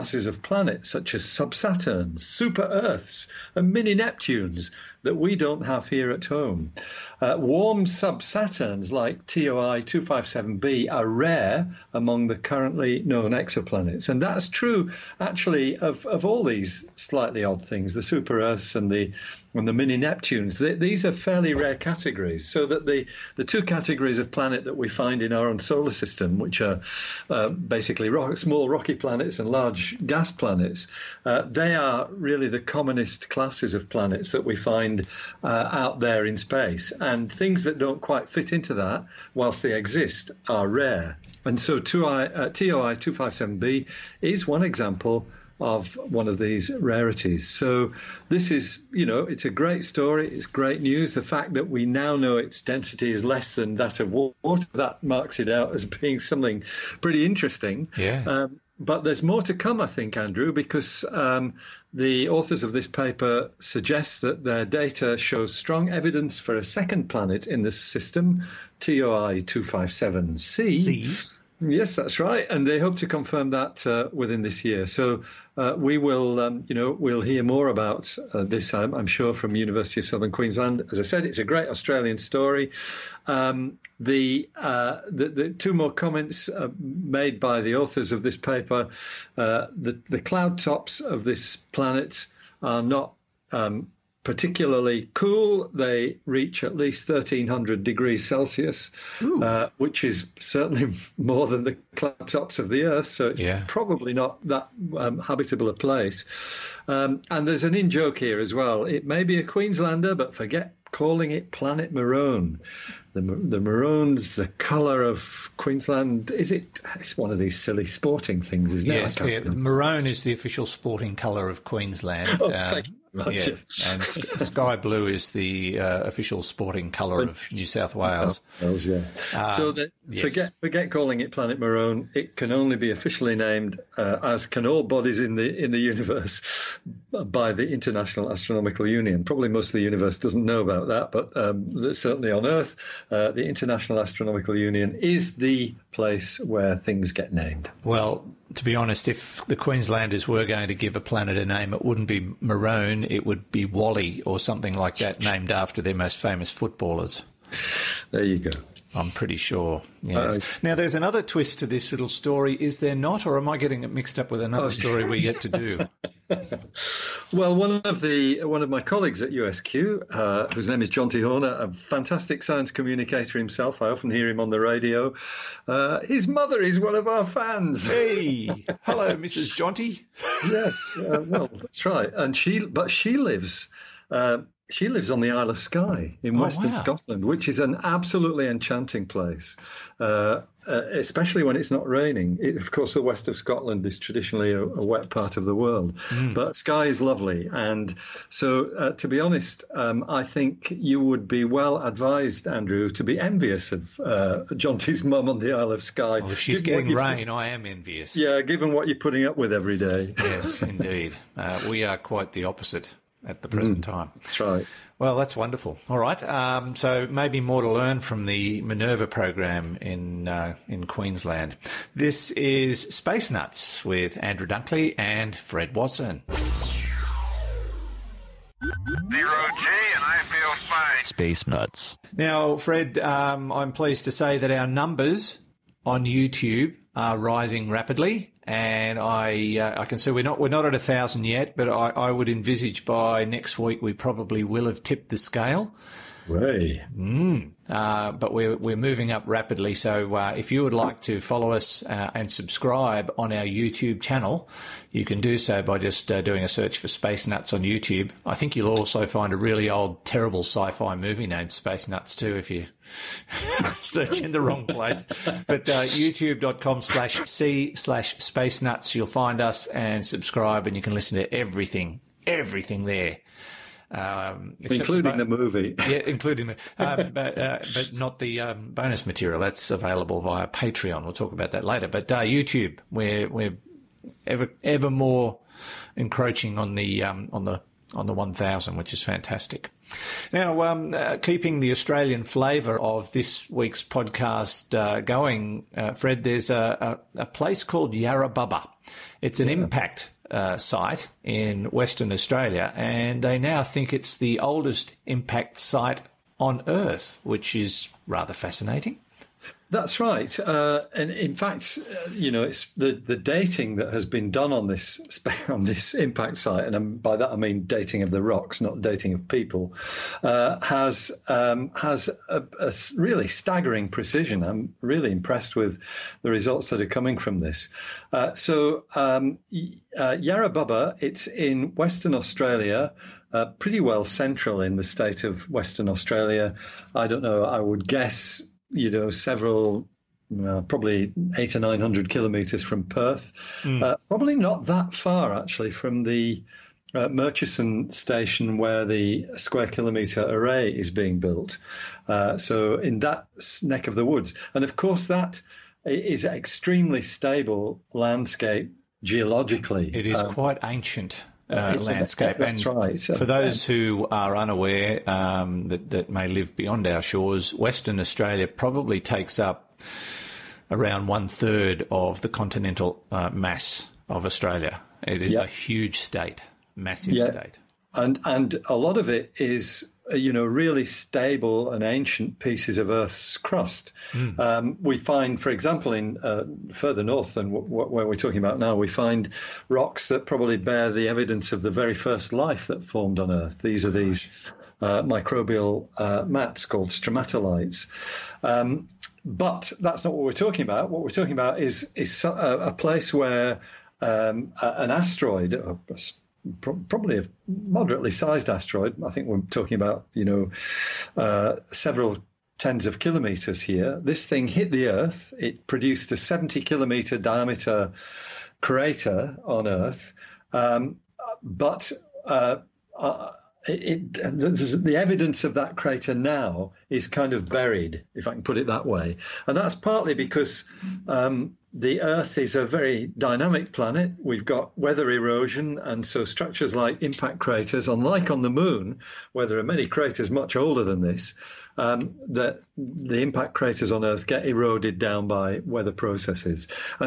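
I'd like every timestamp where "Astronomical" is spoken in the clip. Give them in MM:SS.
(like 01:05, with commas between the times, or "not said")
02:18, 02:24.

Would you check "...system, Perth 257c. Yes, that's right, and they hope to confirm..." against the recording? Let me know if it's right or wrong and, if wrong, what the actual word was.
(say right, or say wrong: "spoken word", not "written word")
wrong: "TOI", not "Perth".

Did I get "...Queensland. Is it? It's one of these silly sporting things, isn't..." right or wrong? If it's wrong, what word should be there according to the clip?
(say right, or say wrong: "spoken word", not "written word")
right.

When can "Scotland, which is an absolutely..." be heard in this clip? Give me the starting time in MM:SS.
03:06.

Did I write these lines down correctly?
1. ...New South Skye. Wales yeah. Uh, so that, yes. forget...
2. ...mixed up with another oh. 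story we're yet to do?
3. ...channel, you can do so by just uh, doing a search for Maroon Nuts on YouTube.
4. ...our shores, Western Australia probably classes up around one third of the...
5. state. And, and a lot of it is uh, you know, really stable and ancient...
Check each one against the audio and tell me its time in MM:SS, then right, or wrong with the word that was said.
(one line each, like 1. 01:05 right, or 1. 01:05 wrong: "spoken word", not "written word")
1. 02:07 wrong: "Wales", not "Skye"
2. 02:43 right
3. 04:14 wrong: "Space", not "Maroon"
4. 06:06 wrong: "takes", not "classes"
5. 06:17 right.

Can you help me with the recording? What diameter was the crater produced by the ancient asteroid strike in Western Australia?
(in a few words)
70 kilometres.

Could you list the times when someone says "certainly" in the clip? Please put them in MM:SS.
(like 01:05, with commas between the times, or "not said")
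01:40, 02:21.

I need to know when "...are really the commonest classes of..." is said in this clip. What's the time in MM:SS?
00:31.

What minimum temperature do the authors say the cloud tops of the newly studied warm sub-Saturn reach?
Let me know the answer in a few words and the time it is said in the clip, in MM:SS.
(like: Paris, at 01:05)
1300 degrees Celsius, at 01:37.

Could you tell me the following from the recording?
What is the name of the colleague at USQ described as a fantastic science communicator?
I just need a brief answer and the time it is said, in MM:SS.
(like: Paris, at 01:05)
Jonty Horner, at 02:50.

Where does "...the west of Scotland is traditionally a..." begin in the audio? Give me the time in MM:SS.
03:12.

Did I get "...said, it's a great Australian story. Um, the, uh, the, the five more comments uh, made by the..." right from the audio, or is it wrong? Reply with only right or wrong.
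wrong.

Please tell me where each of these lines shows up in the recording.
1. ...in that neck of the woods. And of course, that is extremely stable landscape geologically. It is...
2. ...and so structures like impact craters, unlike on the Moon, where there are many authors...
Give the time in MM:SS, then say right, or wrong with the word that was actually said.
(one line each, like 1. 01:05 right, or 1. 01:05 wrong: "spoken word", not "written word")
1. 05:52 right
2. 07:15 wrong: "craters", not "authors".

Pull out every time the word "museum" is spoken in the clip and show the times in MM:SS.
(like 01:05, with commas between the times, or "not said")
not said.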